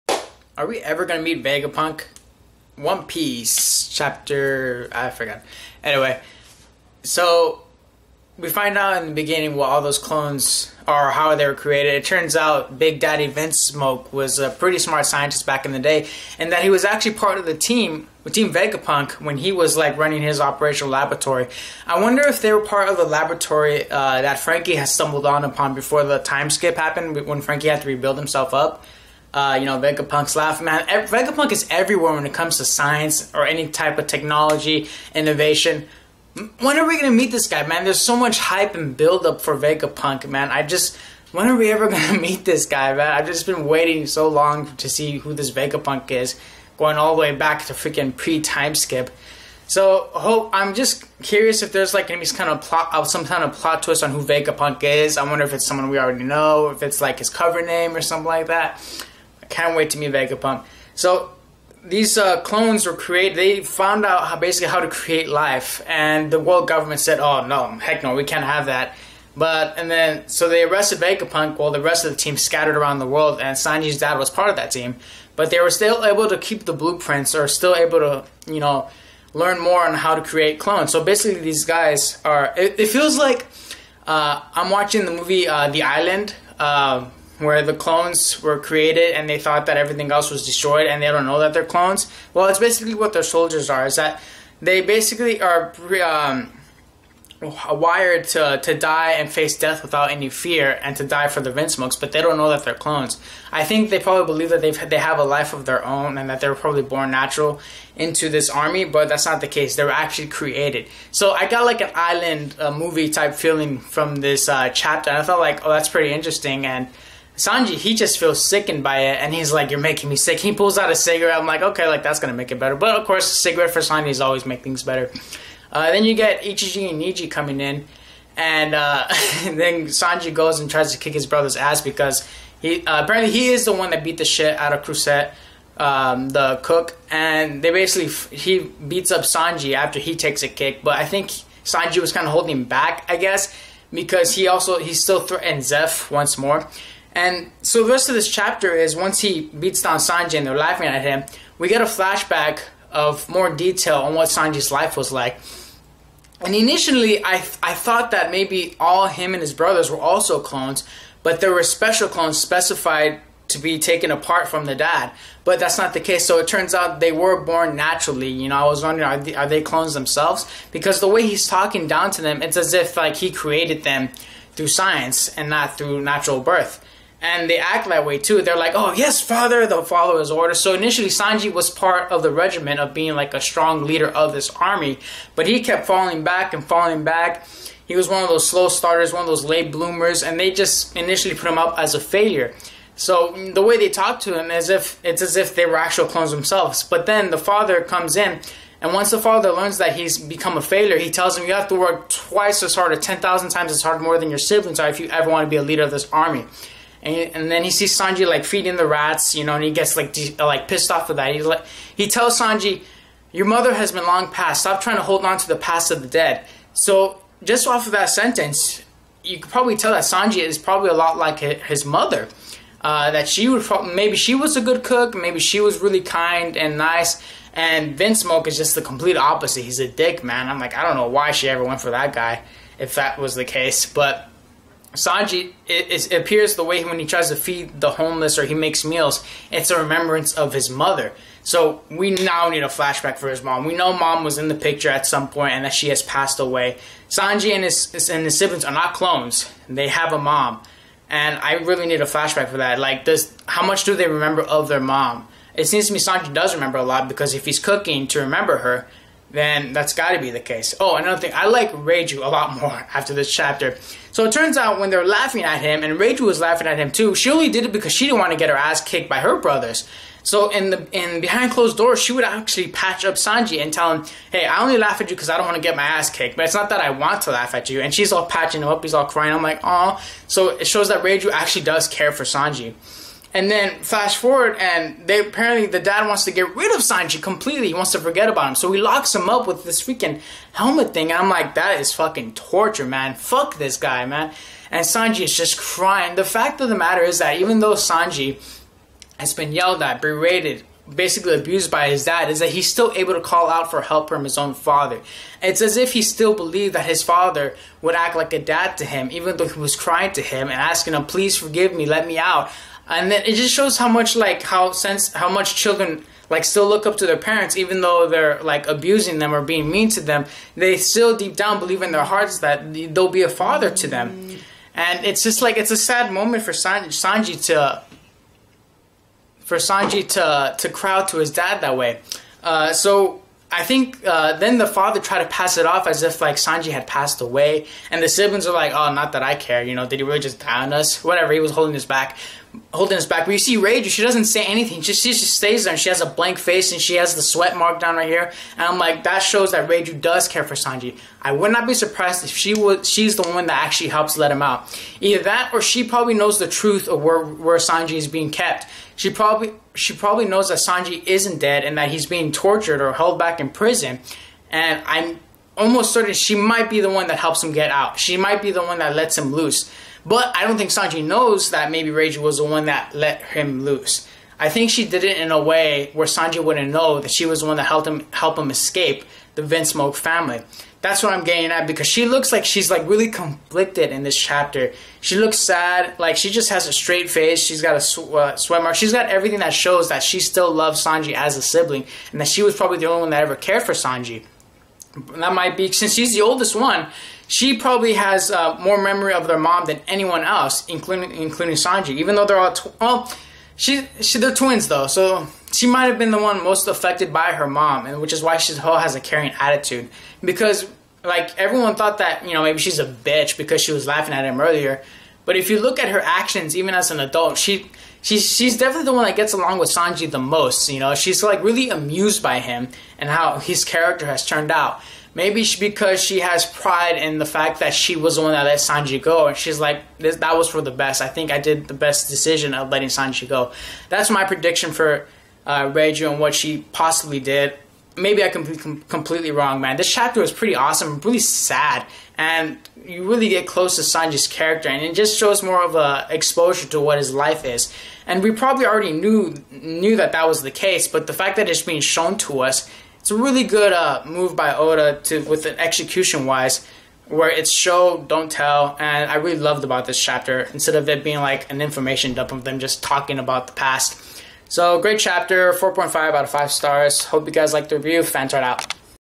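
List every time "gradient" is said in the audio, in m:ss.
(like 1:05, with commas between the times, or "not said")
not said.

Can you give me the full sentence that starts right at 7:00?
You know, she's like really amused by him and how his character has turned out.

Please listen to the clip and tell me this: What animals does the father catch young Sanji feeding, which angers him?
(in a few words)
Rats.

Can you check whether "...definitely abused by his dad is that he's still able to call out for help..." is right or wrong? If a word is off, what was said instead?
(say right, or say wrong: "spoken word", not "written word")
wrong: "basically", not "definitely".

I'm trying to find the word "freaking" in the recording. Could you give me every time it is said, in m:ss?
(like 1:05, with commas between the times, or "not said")
0:47, 4:49.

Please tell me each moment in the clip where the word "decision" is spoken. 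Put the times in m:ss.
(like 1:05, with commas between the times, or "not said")
7:12.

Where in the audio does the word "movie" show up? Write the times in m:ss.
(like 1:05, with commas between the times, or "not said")
1:25, 1:52.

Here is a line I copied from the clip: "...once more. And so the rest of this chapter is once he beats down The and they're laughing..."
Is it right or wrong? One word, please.
wrong.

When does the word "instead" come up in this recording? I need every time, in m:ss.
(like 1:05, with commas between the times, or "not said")
7:40.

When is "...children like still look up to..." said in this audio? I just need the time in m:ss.
5:15.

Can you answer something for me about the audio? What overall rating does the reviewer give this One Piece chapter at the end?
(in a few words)
4.5 out of 5 stars.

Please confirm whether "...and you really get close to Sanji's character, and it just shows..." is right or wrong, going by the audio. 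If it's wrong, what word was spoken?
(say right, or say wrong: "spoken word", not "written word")
right.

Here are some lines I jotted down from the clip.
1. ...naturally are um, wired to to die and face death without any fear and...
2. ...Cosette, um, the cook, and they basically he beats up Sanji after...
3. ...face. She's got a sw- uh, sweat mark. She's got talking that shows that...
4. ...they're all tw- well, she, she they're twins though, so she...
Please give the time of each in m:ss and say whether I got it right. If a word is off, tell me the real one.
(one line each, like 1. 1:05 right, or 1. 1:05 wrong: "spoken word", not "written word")
1. 1:34 wrong: "basically", not "naturally"
2. 2:14 right
3. 6:27 wrong: "everything", not "talking"
4. 6:42 right.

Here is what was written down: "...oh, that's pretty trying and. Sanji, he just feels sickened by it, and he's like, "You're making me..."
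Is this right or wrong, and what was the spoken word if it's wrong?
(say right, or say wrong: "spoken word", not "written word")
wrong: "interesting", not "trying".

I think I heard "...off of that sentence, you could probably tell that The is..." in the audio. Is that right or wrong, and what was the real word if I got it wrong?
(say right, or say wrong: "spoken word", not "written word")
wrong: "Sanji", not "The".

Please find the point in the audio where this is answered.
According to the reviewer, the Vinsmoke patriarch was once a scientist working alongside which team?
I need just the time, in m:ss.
0:18.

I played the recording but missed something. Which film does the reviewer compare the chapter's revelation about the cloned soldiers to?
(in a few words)
The Island.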